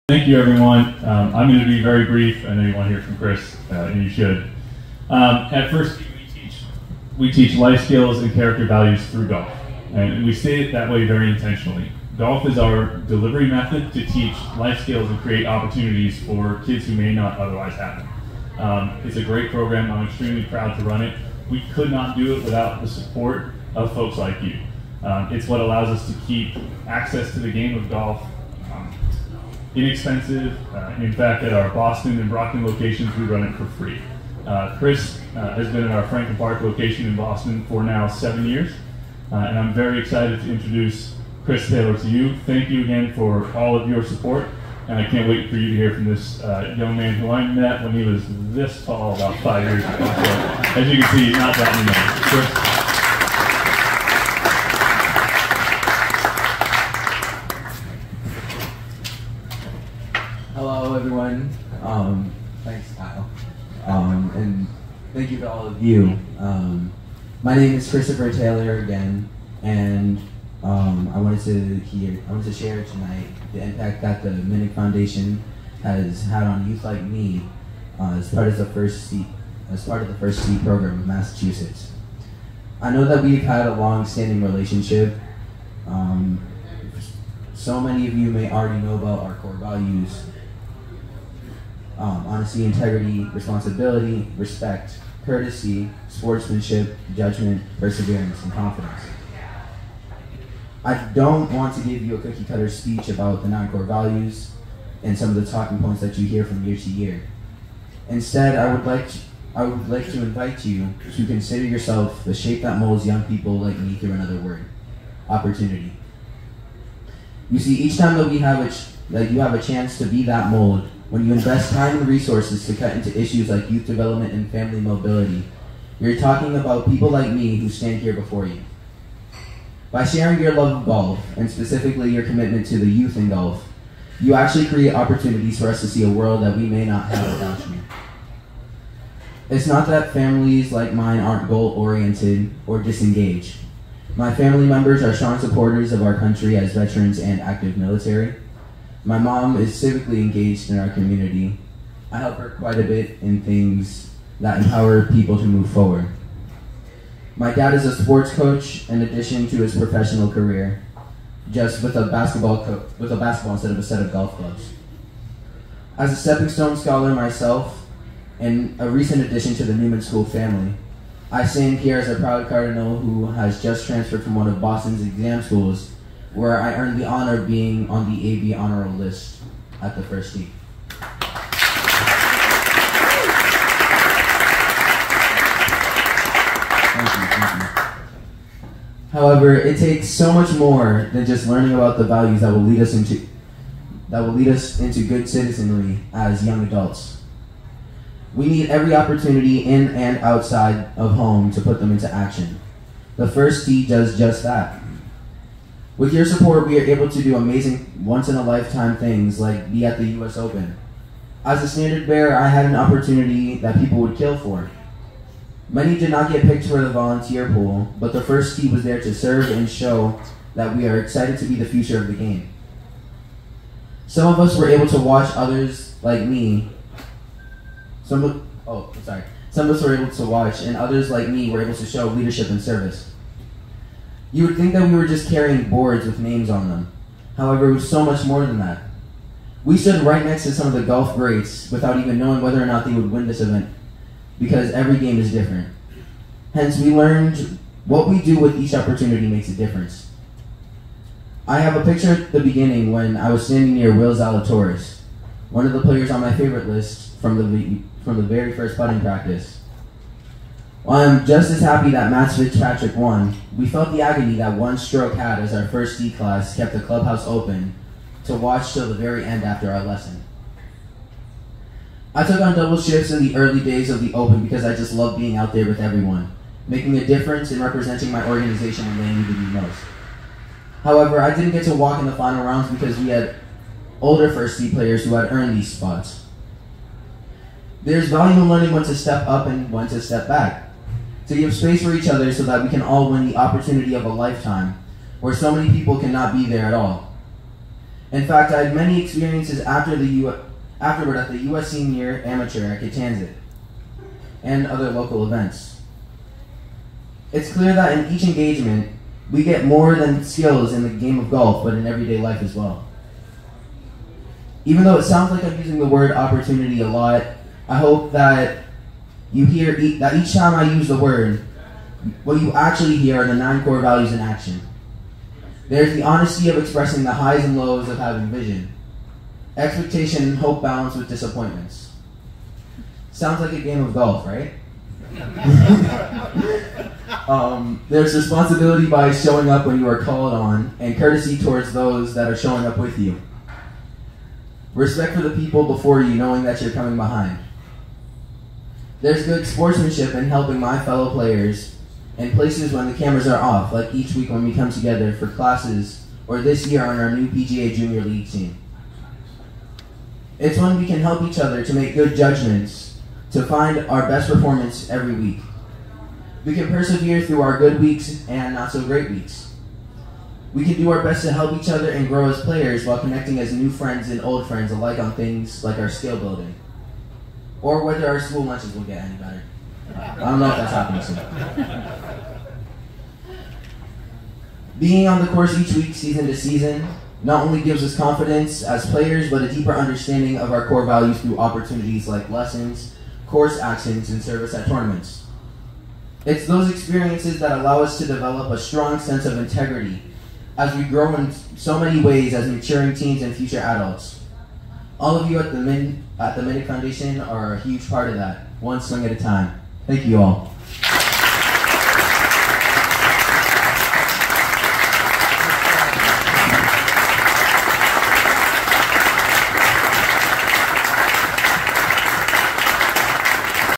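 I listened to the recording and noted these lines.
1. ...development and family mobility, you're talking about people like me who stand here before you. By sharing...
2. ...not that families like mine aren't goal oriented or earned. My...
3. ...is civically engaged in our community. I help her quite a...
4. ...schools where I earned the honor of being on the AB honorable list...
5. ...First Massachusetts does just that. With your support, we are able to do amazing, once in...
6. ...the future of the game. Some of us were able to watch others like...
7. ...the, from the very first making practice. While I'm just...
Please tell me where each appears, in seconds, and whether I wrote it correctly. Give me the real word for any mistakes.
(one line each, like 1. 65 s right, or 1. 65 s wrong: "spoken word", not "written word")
1. 123 s right
2. 139 s wrong: "disengaged", not "earned"
3. 149 s right
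4. 175 s right
5. 203 s wrong: "Tee", not "Massachusetts"
6. 221 s right
7. 257 s wrong: "putting", not "making".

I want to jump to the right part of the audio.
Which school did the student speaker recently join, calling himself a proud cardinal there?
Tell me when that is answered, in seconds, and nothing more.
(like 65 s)
169 s.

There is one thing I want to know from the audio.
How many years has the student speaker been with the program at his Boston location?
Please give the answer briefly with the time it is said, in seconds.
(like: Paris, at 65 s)
7, at 38 s.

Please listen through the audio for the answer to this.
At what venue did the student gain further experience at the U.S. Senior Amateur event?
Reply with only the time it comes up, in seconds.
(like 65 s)
302 s.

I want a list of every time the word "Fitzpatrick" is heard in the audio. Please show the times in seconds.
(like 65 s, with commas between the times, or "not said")
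262 s.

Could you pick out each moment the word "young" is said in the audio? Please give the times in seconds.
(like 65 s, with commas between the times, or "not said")
46 s, 113 s, 196 s.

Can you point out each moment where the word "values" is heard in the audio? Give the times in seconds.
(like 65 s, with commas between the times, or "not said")
8 s, 89 s, 103 s, 192 s, 288 s, 323 s, 390 s.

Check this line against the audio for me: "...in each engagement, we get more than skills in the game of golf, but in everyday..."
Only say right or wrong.
right.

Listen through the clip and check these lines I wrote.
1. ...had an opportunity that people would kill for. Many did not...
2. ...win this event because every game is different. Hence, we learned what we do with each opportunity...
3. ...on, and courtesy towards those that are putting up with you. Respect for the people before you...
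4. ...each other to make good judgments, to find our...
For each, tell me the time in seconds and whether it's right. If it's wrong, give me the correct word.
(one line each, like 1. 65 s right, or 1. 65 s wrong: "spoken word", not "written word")
1. 212 s right
2. 243 s right
3. 340 s wrong: "showing", not "putting"
4. 361 s right.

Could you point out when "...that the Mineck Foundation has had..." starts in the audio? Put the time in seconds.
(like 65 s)
74 s.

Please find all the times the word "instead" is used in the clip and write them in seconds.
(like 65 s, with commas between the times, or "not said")
108 s, 163 s.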